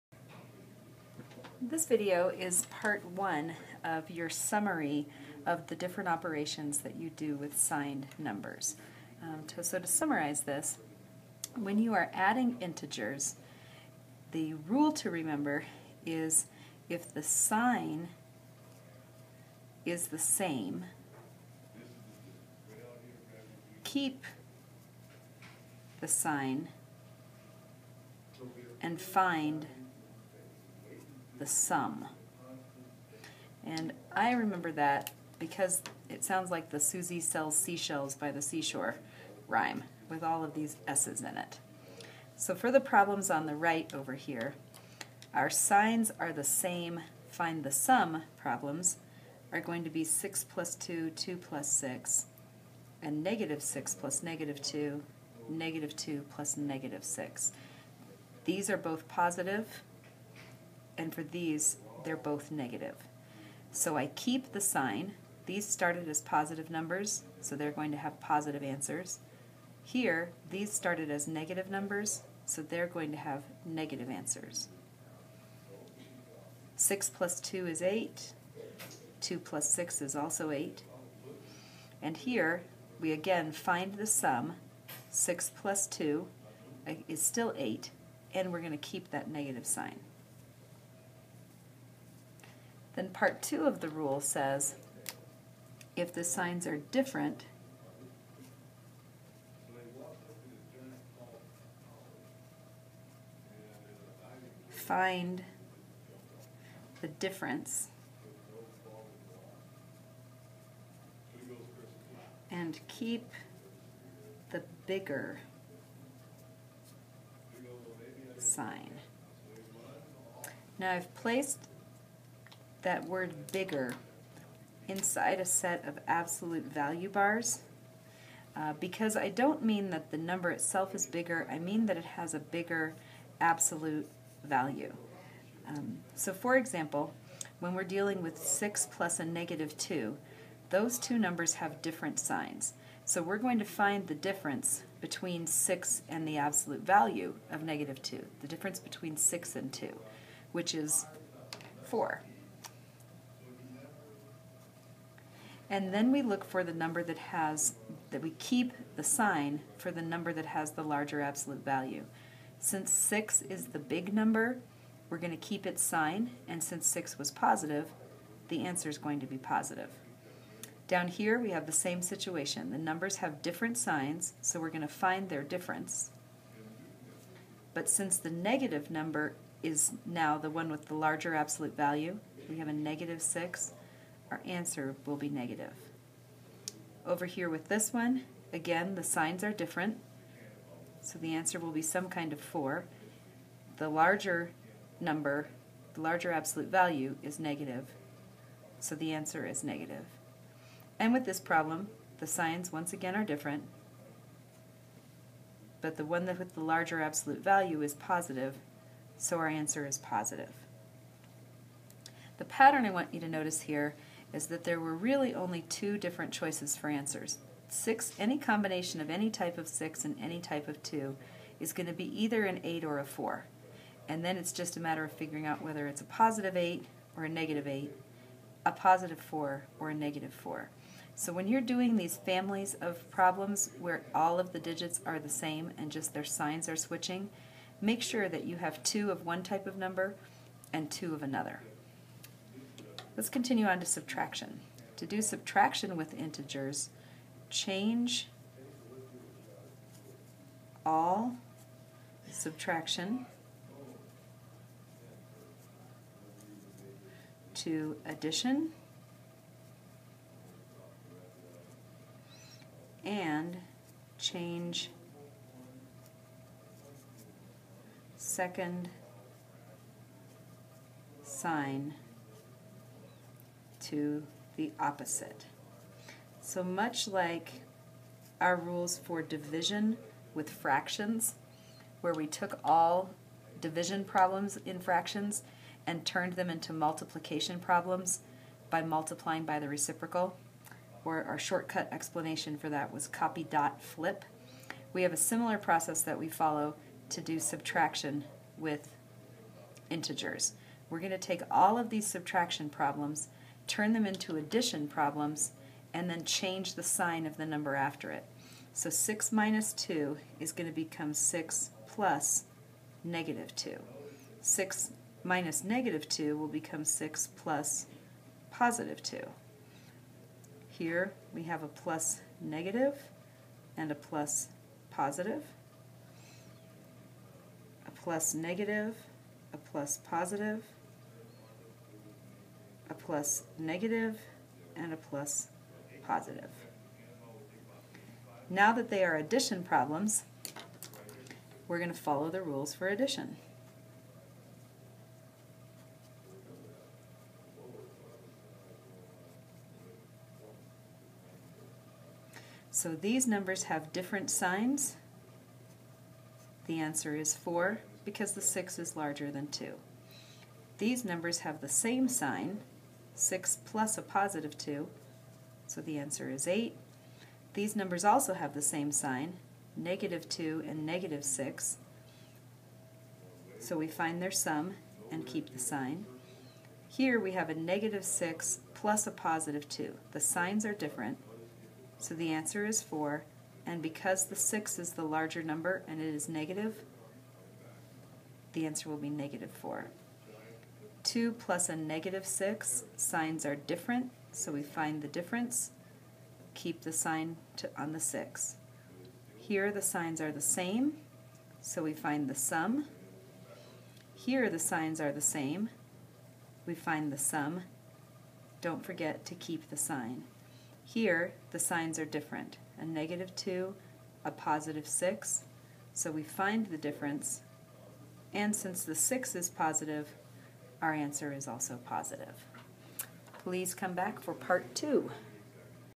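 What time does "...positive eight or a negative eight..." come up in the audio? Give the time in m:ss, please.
3:46.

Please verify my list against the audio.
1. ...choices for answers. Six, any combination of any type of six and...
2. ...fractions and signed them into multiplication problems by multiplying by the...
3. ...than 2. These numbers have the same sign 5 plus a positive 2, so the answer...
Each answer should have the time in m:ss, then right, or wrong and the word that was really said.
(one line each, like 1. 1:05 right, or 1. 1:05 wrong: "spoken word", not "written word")
1. 3:36 right
2. 4:44 wrong: "turned", not "signed"
3. 5:59 wrong: "6", not "5".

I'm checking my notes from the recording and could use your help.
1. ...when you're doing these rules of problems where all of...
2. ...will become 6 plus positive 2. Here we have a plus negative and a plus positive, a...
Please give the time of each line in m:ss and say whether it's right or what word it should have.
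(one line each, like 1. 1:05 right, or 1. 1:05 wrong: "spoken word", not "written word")
1. 3:51 wrong: "families", not "rules"
2. 5:16 right.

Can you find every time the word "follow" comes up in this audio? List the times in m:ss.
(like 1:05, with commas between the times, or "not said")
4:56, 5:41.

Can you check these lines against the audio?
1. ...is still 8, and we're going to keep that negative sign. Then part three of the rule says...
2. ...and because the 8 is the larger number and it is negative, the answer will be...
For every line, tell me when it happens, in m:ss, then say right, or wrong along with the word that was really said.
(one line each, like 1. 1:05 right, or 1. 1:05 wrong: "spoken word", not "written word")
1. 1:27 wrong: "two", not "three"
2. 6:23 wrong: "6", not "8".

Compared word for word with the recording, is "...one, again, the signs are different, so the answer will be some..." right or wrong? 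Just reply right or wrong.
right.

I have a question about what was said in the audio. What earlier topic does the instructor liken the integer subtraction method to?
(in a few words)
division with fractions.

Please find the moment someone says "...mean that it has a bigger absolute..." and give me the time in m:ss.
2:11.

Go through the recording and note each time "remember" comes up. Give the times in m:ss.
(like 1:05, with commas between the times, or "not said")
0:15, 0:34.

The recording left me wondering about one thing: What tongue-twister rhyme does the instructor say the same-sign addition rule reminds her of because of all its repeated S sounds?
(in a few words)
Susie sells seashells.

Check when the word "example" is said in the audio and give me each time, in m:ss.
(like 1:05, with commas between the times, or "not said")
2:16.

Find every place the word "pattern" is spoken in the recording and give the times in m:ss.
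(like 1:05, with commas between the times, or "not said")
3:32.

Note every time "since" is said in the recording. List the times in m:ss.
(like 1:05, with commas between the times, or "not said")
2:42, 2:46, 2:57, 6:58.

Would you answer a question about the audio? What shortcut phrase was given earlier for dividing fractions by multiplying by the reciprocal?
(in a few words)
copy dot flip.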